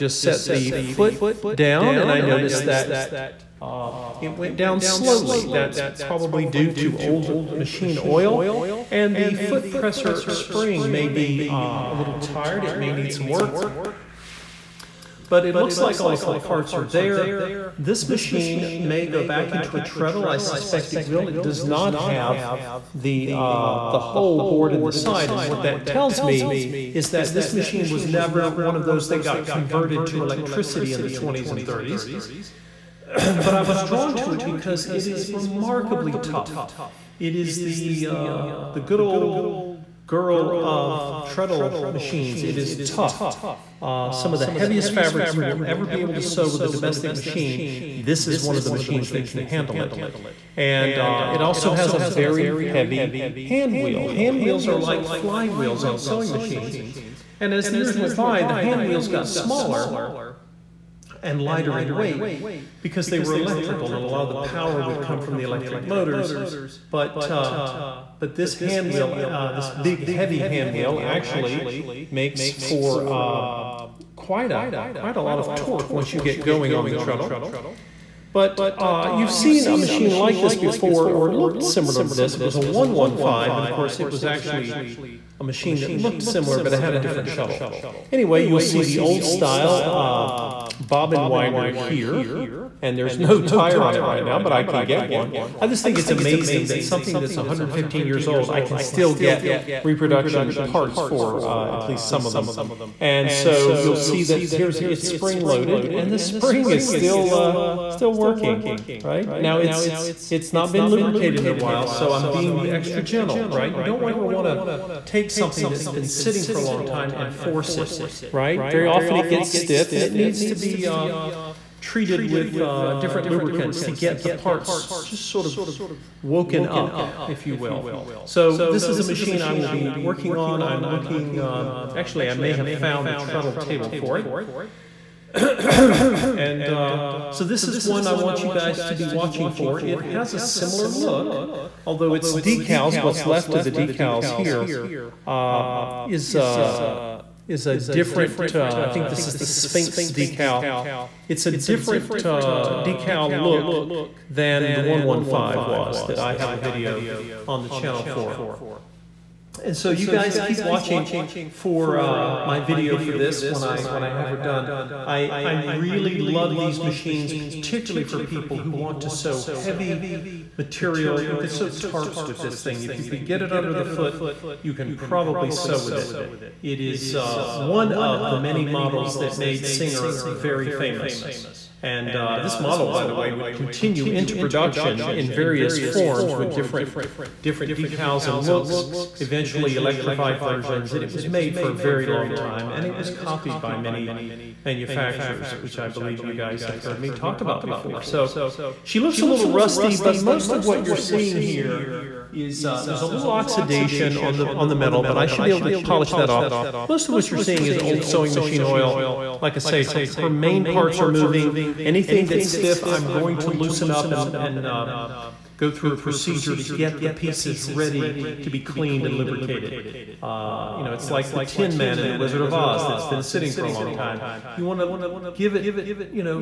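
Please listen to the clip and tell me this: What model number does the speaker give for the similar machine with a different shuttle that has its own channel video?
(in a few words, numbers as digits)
115.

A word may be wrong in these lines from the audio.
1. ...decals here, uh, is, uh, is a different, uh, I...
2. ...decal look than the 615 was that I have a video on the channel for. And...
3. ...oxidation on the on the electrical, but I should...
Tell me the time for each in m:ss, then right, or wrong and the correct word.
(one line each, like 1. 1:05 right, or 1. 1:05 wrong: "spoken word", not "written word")
1. 2:23 right
2. 2:32 wrong: "115", not "615"
3. 3:23 wrong: "metal", not "electrical".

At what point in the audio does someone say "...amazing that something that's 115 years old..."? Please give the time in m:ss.
1:36.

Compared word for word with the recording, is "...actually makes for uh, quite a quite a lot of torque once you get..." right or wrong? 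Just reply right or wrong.
right.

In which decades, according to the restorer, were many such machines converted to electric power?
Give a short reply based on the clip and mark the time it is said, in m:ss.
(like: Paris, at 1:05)
20s and 30s, at 0:31.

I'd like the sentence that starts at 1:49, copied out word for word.
Now it's it's not been lubricated in a while, so I'm being extra gentle, right?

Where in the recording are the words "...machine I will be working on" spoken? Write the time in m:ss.
2:09.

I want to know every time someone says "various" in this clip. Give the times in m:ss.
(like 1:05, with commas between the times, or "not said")
3:05.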